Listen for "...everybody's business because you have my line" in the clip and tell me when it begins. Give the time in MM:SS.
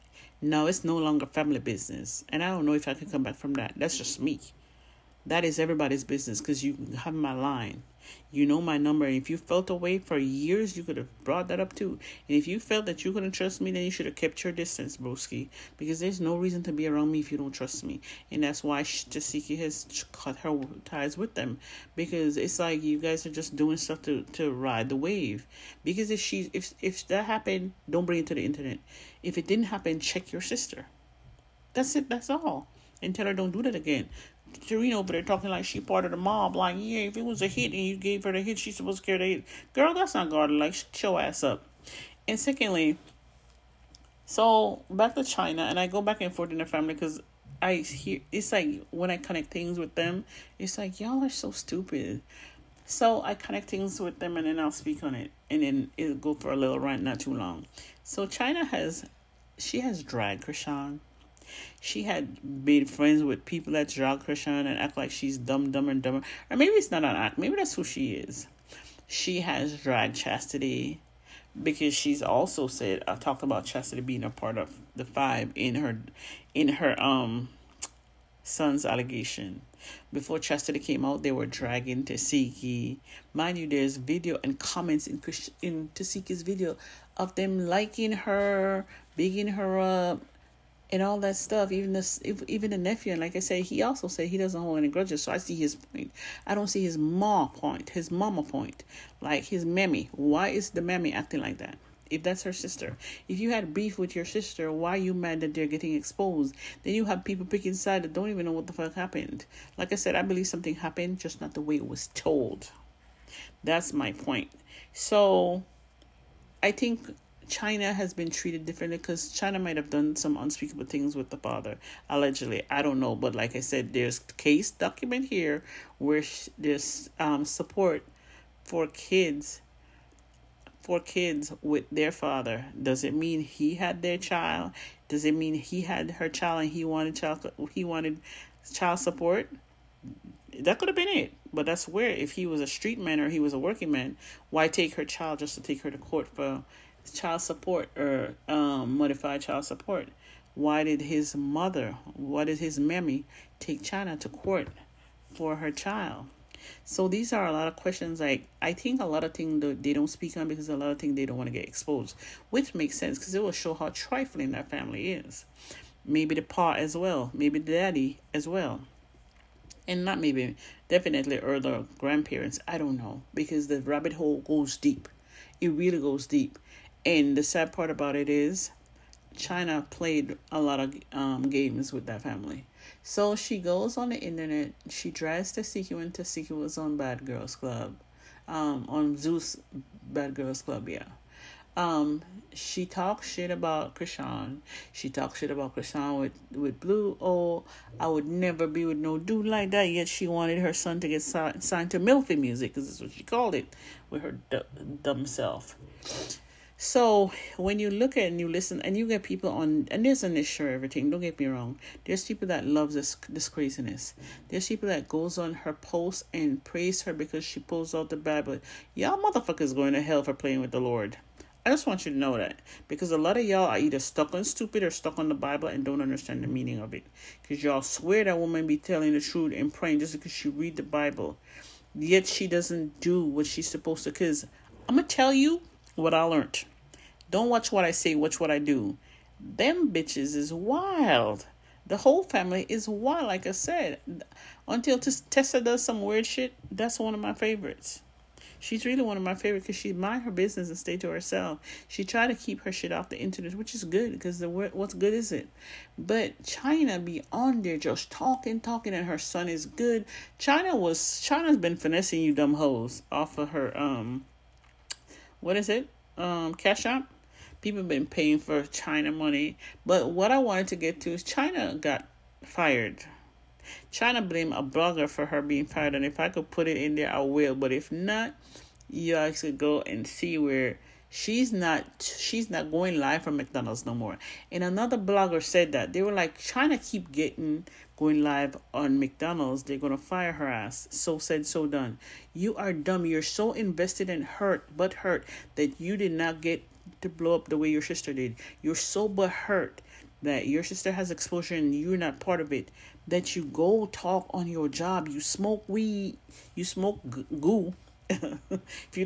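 00:05.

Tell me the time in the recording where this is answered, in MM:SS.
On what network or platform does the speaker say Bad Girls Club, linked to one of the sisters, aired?
03:09.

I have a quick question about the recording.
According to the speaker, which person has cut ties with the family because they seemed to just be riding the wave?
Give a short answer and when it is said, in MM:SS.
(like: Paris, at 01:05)
Jasiki, at 00:18.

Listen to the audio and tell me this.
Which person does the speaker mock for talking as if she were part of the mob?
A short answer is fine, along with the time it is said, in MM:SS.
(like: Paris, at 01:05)
Serena, at 00:34.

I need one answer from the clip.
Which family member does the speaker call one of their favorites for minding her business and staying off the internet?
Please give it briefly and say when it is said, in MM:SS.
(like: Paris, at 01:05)
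Tessa, at 04:04.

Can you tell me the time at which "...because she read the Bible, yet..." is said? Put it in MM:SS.
03:50.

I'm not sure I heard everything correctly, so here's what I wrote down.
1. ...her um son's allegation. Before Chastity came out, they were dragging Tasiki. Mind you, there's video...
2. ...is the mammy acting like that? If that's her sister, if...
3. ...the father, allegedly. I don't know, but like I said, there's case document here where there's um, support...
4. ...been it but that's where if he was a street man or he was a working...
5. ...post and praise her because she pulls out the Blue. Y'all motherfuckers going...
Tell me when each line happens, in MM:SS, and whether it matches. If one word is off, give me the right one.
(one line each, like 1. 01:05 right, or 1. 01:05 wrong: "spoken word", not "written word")
1. 01:16 right
2. 01:40 right
3. 02:01 right
4. 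02:20 right
5. 03:35 wrong: "Bible", not "Blue".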